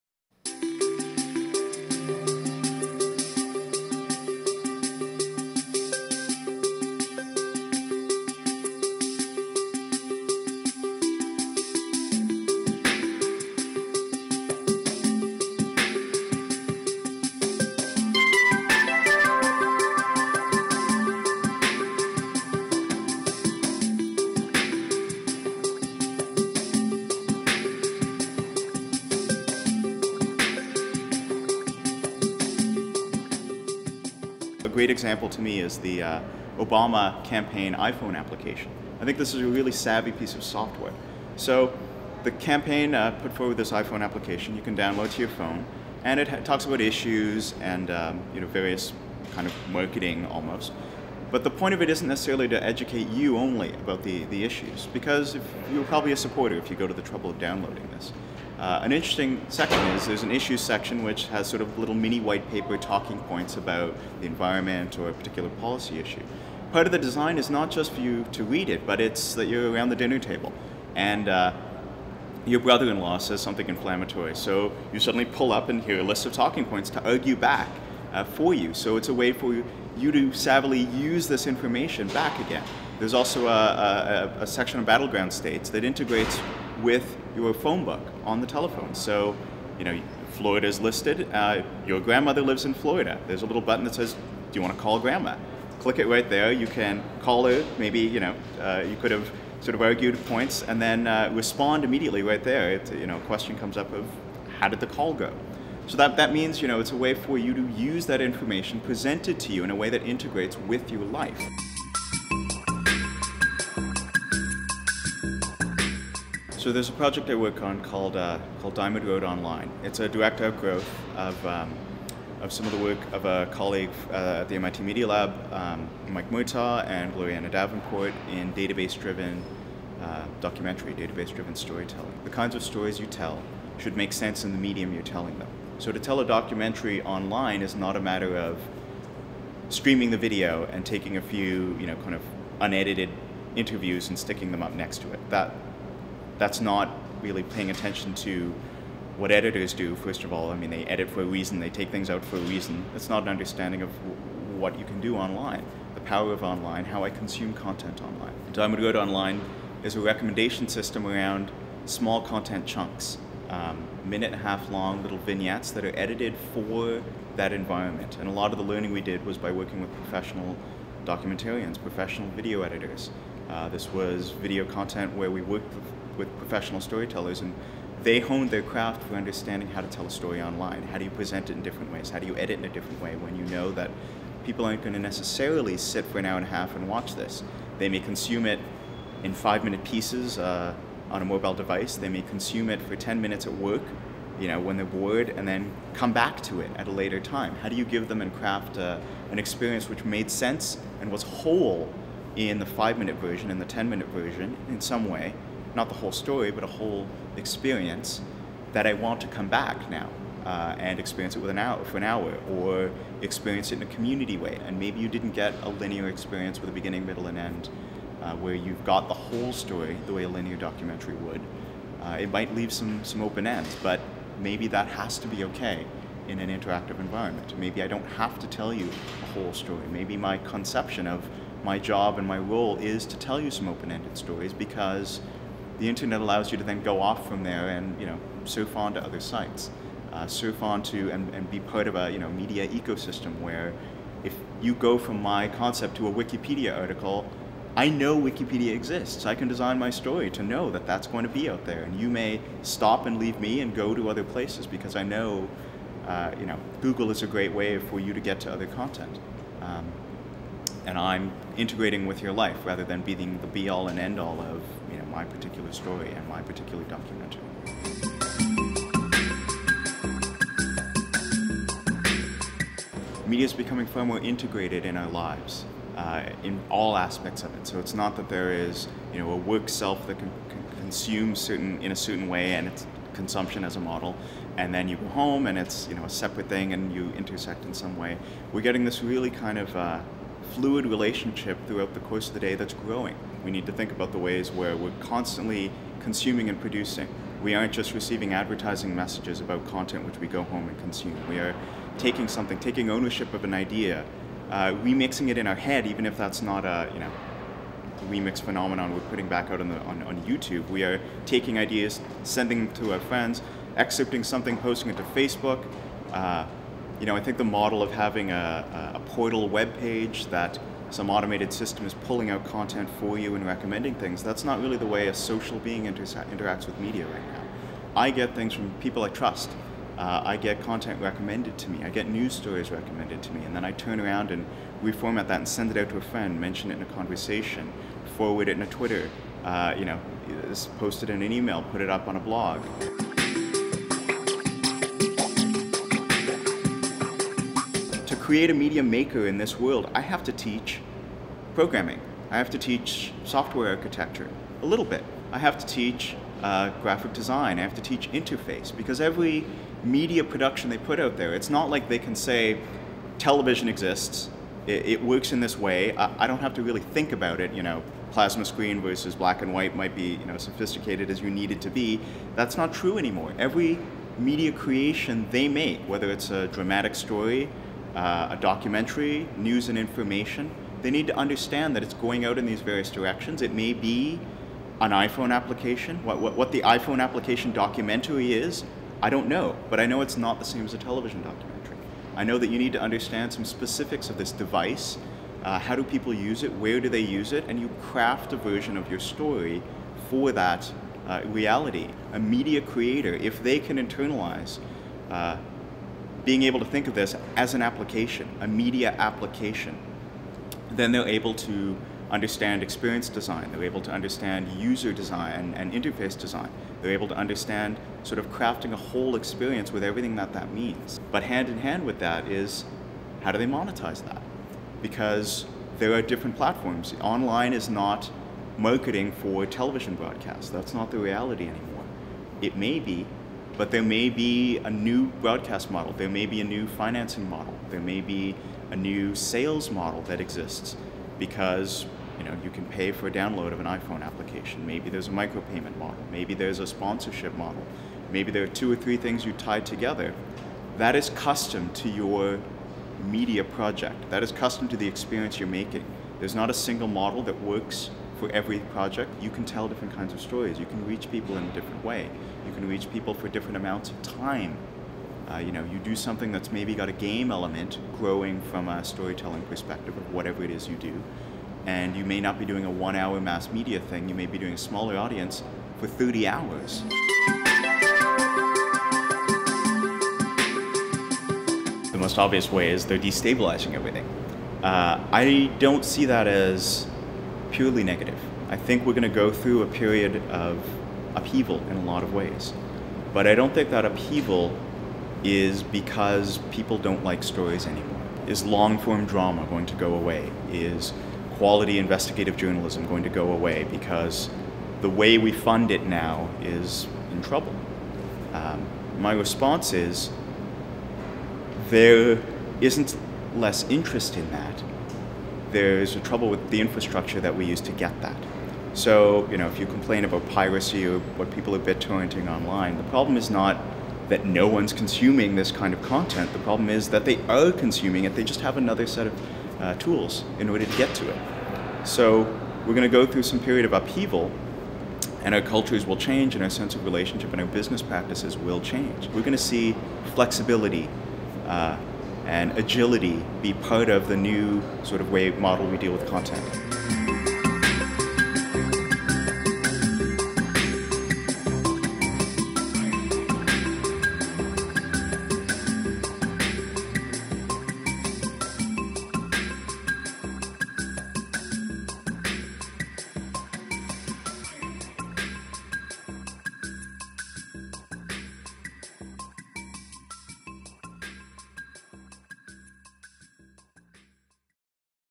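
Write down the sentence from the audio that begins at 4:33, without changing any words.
Media is becoming far more integrated in our lives.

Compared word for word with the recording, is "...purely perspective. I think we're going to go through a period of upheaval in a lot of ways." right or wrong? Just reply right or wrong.
wrong.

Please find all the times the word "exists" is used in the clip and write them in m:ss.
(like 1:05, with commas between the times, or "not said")
4:08, 6:03, 7:20.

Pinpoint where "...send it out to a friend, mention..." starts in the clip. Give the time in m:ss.
5:35.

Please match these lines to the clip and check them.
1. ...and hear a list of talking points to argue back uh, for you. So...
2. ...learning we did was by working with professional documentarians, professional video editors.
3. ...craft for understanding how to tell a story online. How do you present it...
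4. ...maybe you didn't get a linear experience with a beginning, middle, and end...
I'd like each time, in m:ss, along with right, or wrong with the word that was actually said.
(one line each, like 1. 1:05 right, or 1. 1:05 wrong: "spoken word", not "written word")
1. 1:15 right
2. 2:48 right
3. 2:58 right
4. 3:34 right.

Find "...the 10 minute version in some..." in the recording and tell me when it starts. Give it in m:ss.
3:23.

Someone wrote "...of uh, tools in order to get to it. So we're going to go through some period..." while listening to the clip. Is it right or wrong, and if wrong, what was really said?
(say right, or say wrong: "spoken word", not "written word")
right.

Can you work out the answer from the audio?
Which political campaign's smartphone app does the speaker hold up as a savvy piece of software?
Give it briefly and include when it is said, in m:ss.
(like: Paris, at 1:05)
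Obama campaign, at 0:36.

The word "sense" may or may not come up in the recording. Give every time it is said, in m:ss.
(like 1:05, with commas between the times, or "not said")
2:14, 3:20, 8:56.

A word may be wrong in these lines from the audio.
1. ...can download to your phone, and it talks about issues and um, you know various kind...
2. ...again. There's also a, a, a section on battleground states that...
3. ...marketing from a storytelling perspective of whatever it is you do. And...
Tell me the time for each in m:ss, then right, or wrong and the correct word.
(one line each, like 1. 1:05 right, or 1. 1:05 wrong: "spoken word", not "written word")
1. 0:44 right
2. 1:22 right
3. 7:47 wrong: "growing", not "marketing".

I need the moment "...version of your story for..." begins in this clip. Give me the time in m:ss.
6:38.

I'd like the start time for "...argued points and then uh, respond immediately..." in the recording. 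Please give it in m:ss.
1:39.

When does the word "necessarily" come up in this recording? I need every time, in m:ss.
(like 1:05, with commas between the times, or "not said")
0:52, 3:04.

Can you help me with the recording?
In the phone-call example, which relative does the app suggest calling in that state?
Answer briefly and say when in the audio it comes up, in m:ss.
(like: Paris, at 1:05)
Grandma, at 1:34.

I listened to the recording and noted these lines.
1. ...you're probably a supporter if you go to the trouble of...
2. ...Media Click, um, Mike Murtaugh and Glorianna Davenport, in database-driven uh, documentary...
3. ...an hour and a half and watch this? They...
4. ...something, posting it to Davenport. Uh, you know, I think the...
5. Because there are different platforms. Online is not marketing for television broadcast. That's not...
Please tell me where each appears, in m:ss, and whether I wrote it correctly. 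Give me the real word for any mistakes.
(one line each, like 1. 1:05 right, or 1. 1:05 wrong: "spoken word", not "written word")
1. 0:55 right
2. 2:04 wrong: "Lab", not "Click"
3. 3:06 right
4. 5:14 wrong: "Facebook", not "Davenport"
5. 7:04 right.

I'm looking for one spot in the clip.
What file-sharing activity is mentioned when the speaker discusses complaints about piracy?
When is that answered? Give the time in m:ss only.
8:41.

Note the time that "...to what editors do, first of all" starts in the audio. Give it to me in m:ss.
2:28.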